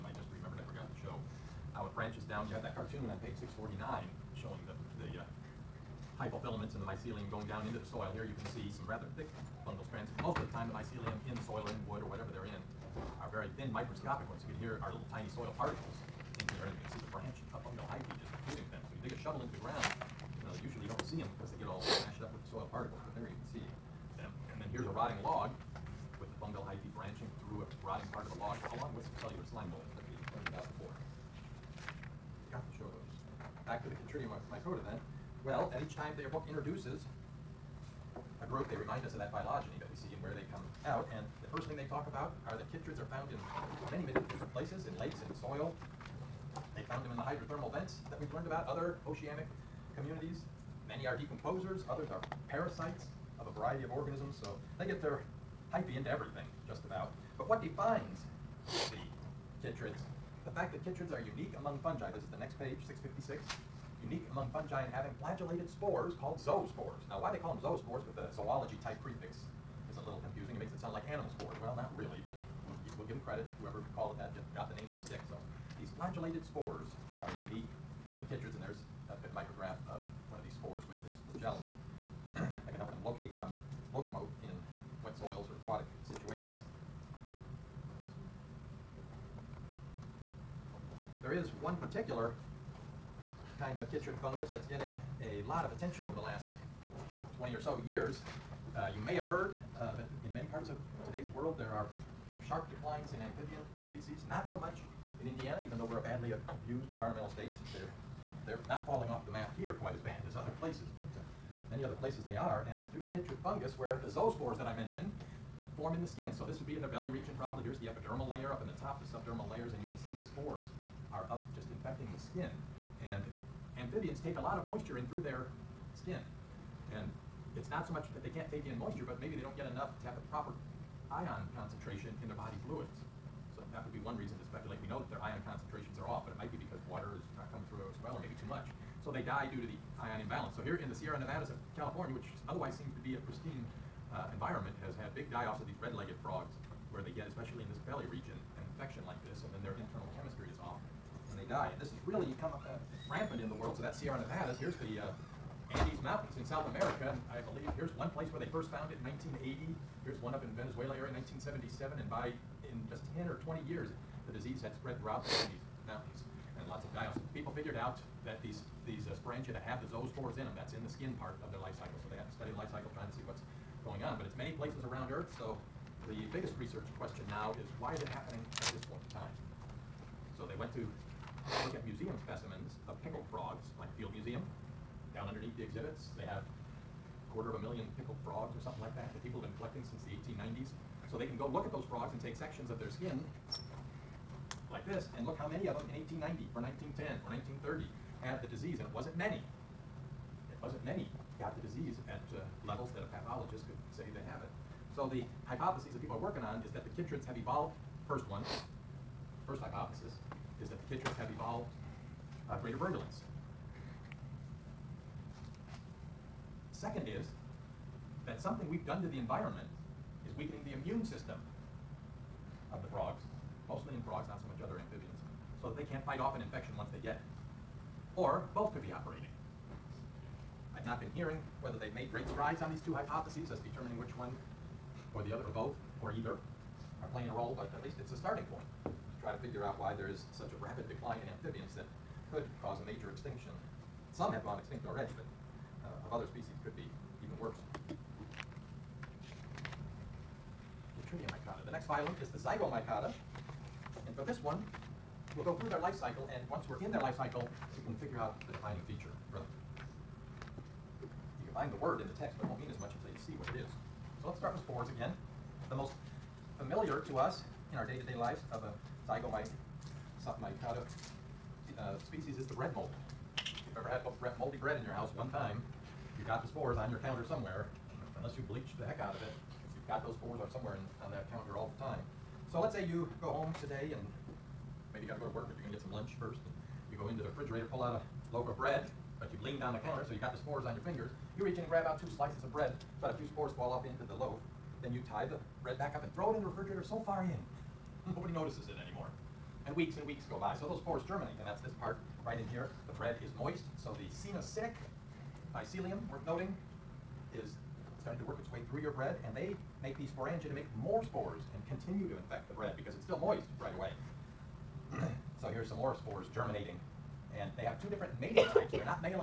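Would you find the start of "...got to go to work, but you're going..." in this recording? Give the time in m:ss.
4:45.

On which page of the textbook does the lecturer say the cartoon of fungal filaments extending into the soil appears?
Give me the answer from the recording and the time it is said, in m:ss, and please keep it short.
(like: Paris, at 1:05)
649, at 0:03.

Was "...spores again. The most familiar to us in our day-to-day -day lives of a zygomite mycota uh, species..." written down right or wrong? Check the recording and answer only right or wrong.
right.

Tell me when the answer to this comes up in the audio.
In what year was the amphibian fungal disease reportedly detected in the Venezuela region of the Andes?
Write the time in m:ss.
2:41.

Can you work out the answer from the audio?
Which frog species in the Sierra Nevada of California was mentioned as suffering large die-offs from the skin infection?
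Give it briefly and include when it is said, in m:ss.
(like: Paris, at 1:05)
red-legged frogs, at 2:25.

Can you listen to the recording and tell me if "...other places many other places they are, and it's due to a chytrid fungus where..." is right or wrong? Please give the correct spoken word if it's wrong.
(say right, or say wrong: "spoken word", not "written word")
right.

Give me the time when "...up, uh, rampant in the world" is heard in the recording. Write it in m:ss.
2:32.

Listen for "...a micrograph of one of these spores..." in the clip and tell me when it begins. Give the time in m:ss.
1:19.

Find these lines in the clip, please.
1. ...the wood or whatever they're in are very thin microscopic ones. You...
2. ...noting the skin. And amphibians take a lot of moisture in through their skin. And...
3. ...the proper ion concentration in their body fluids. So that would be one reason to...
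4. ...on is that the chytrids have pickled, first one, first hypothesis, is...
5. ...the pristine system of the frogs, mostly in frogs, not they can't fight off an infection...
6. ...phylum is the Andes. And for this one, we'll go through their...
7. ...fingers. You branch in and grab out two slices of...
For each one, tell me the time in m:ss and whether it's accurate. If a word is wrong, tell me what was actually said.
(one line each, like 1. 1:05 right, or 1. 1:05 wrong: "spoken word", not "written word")
1. 0:11 right
2. 2:01 wrong: "infecting", not "noting"
3. 2:10 right
4. 3:26 wrong: "evolved", not "pickled"
5. 3:40 wrong: "immune", not "pristine"
6. 4:11 wrong: "Zygomycota", not "Andes"
7. 4:50 wrong: "reach", not "branch".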